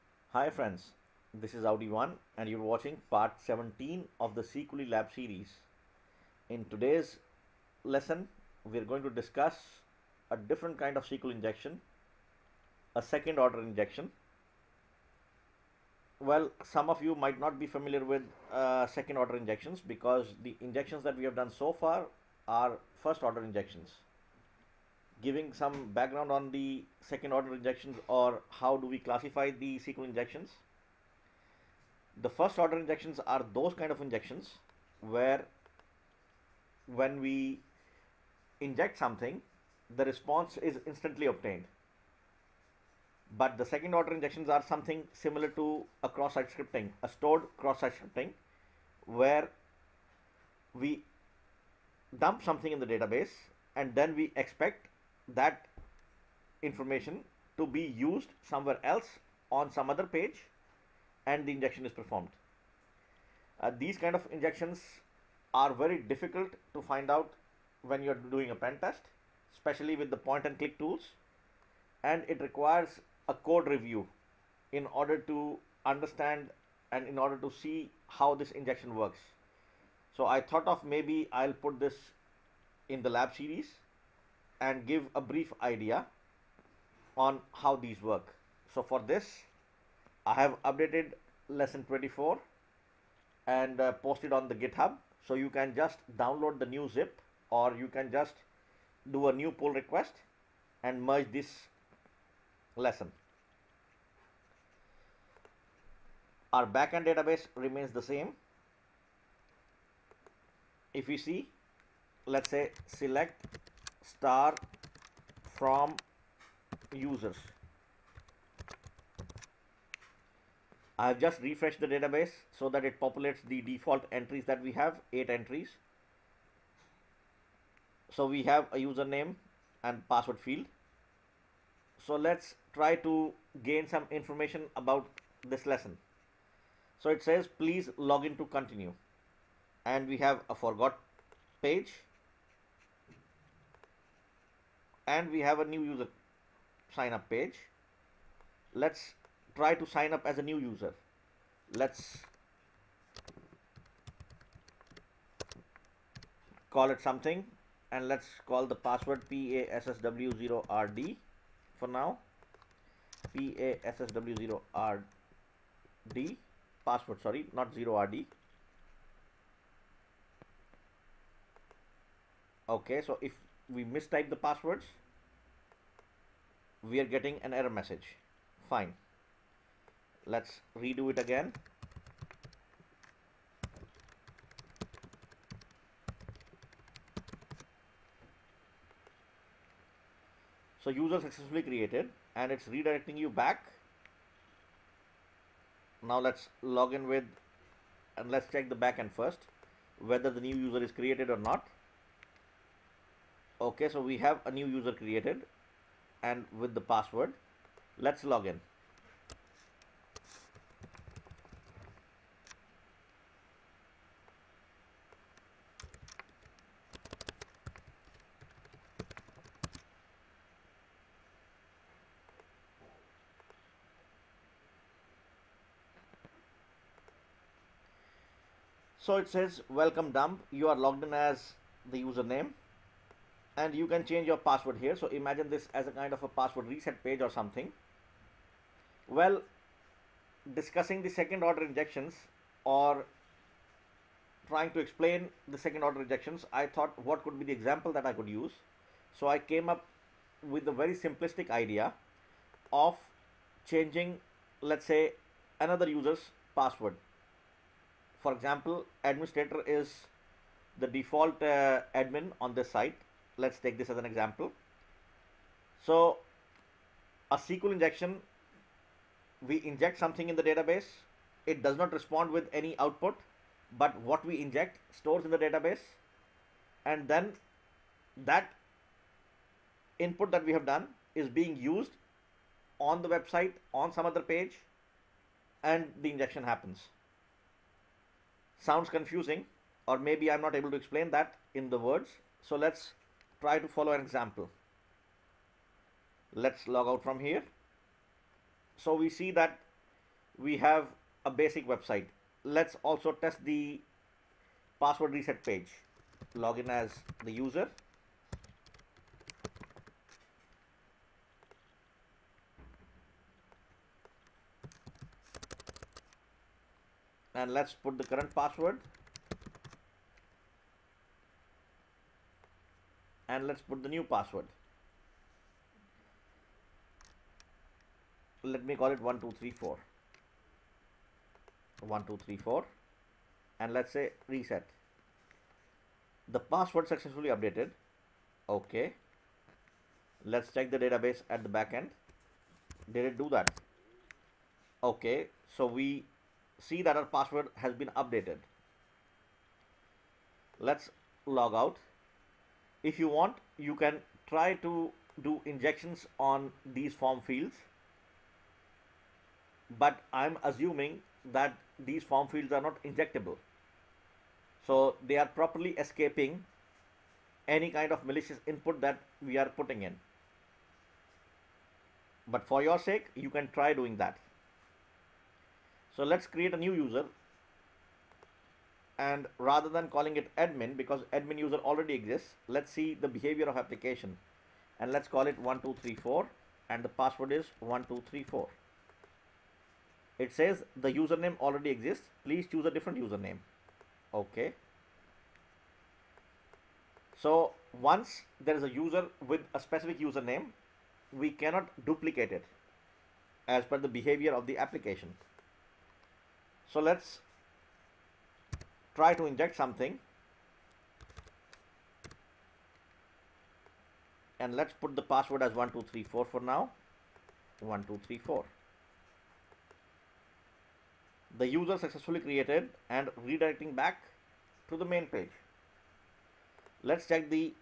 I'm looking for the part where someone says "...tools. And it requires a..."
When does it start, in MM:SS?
01:10.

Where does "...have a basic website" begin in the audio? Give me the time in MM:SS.
05:00.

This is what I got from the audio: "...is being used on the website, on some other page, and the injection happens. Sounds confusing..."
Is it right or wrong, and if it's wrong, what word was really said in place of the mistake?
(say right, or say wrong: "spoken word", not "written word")
right.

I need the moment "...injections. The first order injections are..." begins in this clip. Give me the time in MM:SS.
00:30.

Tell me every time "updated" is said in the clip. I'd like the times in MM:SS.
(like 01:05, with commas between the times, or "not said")
01:30, 05:37, 05:48.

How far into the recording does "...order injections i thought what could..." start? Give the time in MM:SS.
04:05.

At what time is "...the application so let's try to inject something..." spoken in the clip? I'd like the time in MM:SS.
06:44.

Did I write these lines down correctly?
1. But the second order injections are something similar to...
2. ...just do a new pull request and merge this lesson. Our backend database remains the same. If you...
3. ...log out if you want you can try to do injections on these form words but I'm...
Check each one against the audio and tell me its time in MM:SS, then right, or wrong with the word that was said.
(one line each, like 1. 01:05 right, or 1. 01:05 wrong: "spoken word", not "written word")
1. 00:43 right
2. 01:38 right
3. 05:51 wrong: "fields", not "words".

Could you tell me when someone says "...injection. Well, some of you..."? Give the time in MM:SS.
00:13.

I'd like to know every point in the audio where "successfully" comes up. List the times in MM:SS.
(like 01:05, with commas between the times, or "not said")
03:11, 05:36, 07:01.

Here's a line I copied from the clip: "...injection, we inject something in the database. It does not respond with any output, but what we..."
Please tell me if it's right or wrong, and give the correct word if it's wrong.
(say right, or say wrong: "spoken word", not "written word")
right.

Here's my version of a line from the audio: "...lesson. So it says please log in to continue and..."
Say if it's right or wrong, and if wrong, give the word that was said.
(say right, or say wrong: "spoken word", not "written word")
right.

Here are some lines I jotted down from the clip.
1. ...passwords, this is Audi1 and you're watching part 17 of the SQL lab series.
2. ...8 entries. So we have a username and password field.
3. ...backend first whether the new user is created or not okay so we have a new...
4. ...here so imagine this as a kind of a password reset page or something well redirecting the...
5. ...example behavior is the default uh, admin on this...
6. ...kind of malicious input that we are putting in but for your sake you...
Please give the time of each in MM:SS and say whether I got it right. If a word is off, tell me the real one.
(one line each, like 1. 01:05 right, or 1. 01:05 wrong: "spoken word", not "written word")
1. 00:00 wrong: "friends", not "passwords"
2. 02:05 right
3. 03:18 right
4. 03:54 wrong: "discussing", not "redirecting"
5. 04:18 wrong: "administrator", not "behavior"
6. 06:07 right.